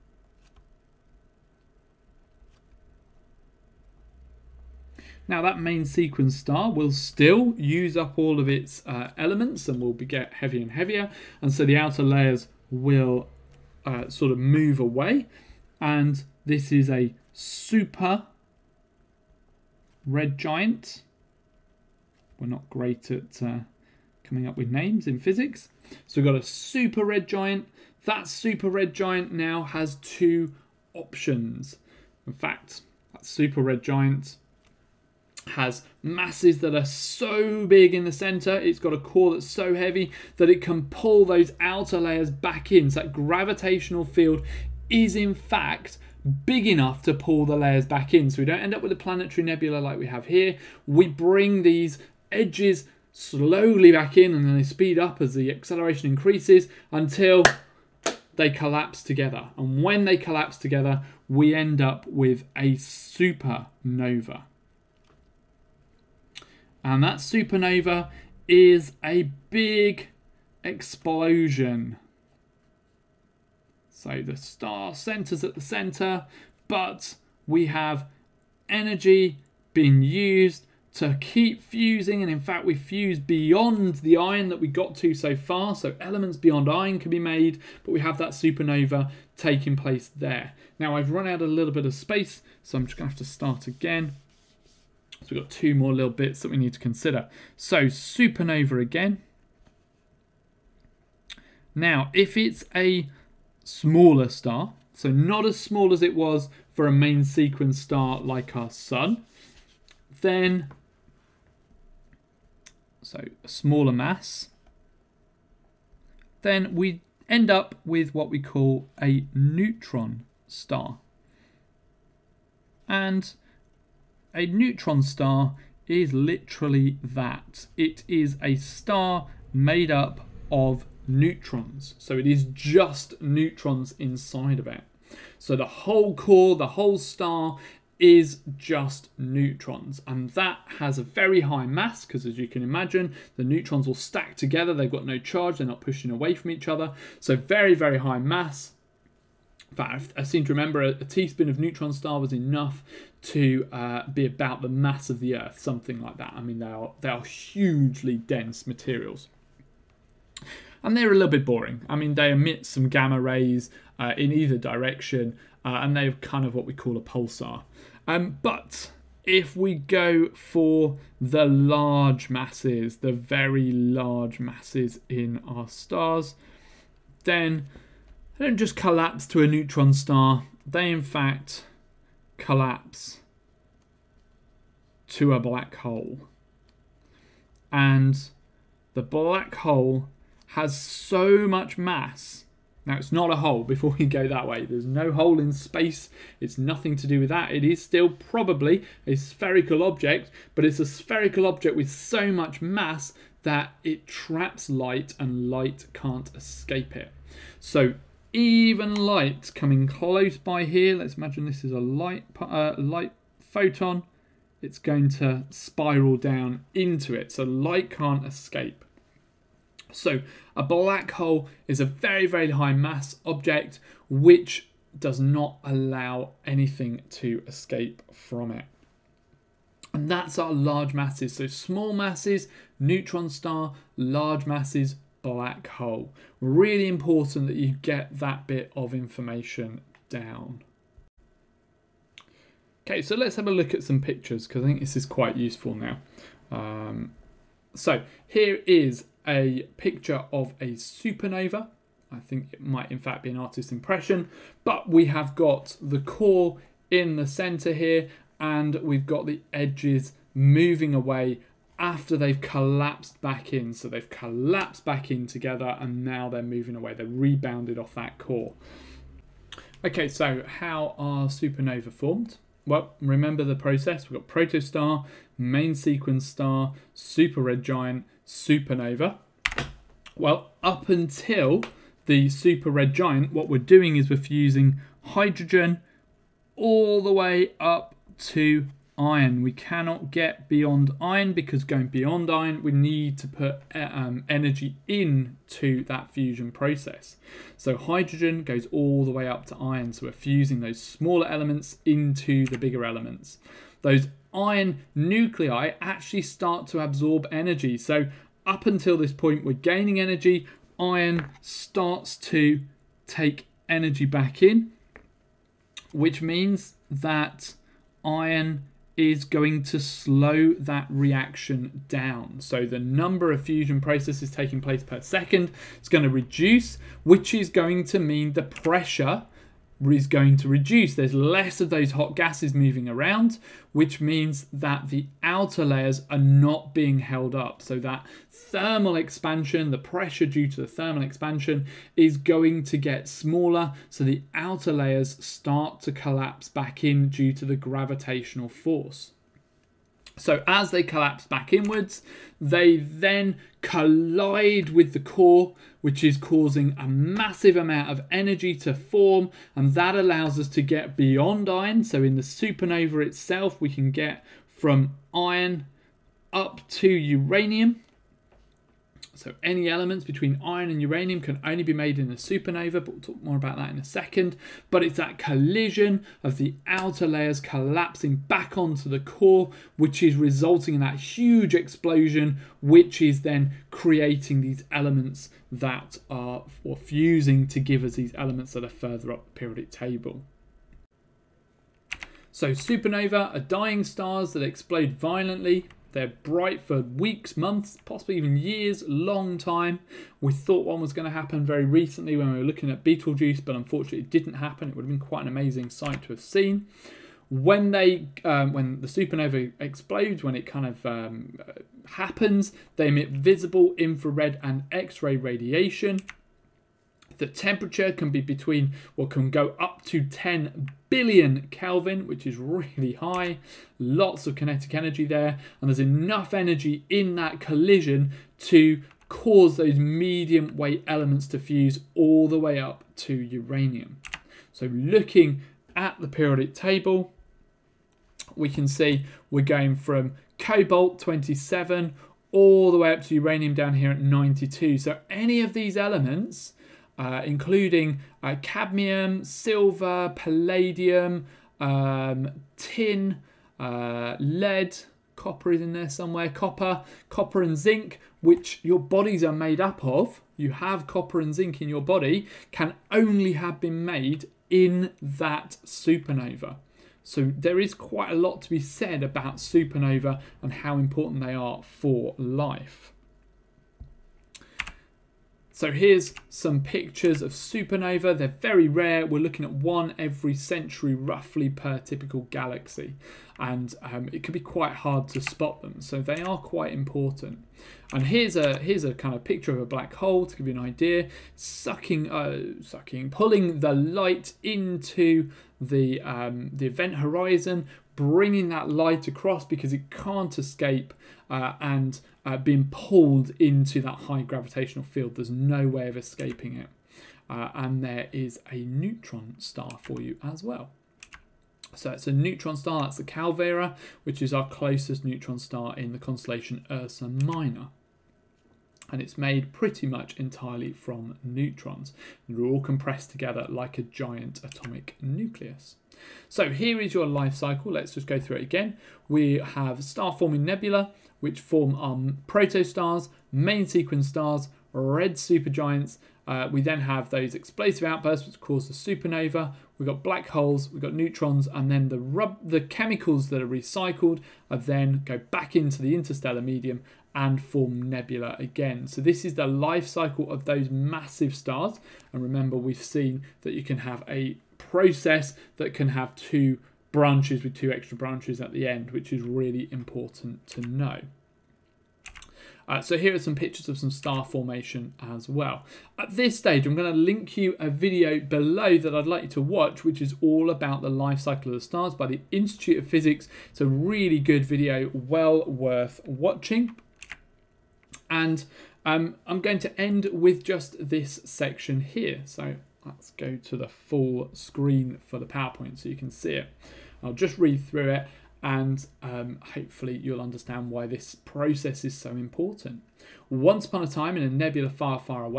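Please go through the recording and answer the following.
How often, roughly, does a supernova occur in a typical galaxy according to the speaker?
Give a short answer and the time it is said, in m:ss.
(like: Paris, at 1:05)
one every century, at 7:59.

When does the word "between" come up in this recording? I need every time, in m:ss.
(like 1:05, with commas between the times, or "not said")
6:10, 6:58.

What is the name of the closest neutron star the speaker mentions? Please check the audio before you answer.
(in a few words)
Calvera.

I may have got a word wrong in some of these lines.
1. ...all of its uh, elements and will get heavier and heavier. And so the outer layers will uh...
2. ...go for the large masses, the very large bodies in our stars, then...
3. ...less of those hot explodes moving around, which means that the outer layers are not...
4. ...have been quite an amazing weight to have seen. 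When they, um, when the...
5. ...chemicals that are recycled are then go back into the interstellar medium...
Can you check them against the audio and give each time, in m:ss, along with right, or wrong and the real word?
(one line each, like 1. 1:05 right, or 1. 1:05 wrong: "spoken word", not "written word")
1. 0:08 right
2. 2:49 wrong: "masses", not "bodies"
3. 5:31 wrong: "gases", not "explodes"
4. 6:44 wrong: "sight", not "weight"
5. 9:02 right.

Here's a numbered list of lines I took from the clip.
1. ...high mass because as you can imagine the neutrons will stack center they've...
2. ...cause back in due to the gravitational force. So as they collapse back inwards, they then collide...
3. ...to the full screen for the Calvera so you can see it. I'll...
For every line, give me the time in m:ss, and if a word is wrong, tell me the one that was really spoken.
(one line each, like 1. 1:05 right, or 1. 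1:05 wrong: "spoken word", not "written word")
1. 2:21 wrong: "together", not "center"
2. 5:45 wrong: "collapse", not "cause"
3. 9:43 wrong: "PowerPoint", not "Calvera".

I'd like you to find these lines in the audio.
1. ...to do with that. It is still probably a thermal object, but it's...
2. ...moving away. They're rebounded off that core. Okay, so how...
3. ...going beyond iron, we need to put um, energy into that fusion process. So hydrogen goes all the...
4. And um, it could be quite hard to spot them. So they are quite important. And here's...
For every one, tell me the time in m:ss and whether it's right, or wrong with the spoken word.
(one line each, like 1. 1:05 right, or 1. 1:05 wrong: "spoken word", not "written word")
1. 3:16 wrong: "spherical", not "thermal"
2. 4:26 right
3. 4:51 right
4. 8:03 right.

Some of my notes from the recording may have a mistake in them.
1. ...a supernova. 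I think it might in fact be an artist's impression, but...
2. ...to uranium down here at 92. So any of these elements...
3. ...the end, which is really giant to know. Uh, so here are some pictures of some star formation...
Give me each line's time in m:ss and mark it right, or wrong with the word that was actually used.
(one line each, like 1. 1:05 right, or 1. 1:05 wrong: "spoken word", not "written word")
1. 4:10 right
2. 7:23 right
3. 9:18 wrong: "important", not "giant".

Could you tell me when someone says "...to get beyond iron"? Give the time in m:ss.
6:00.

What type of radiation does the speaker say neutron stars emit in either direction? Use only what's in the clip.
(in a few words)
gamma rays.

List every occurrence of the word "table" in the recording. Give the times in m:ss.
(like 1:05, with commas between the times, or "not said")
6:29, 7:16.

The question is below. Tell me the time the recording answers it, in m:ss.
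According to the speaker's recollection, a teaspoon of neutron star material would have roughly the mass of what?
2:35.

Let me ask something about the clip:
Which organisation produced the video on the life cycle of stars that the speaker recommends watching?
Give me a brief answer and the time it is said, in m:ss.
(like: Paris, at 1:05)
Institute of Physics, at 9:32.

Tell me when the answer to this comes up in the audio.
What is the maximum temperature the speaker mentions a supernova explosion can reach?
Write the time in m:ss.
7:00.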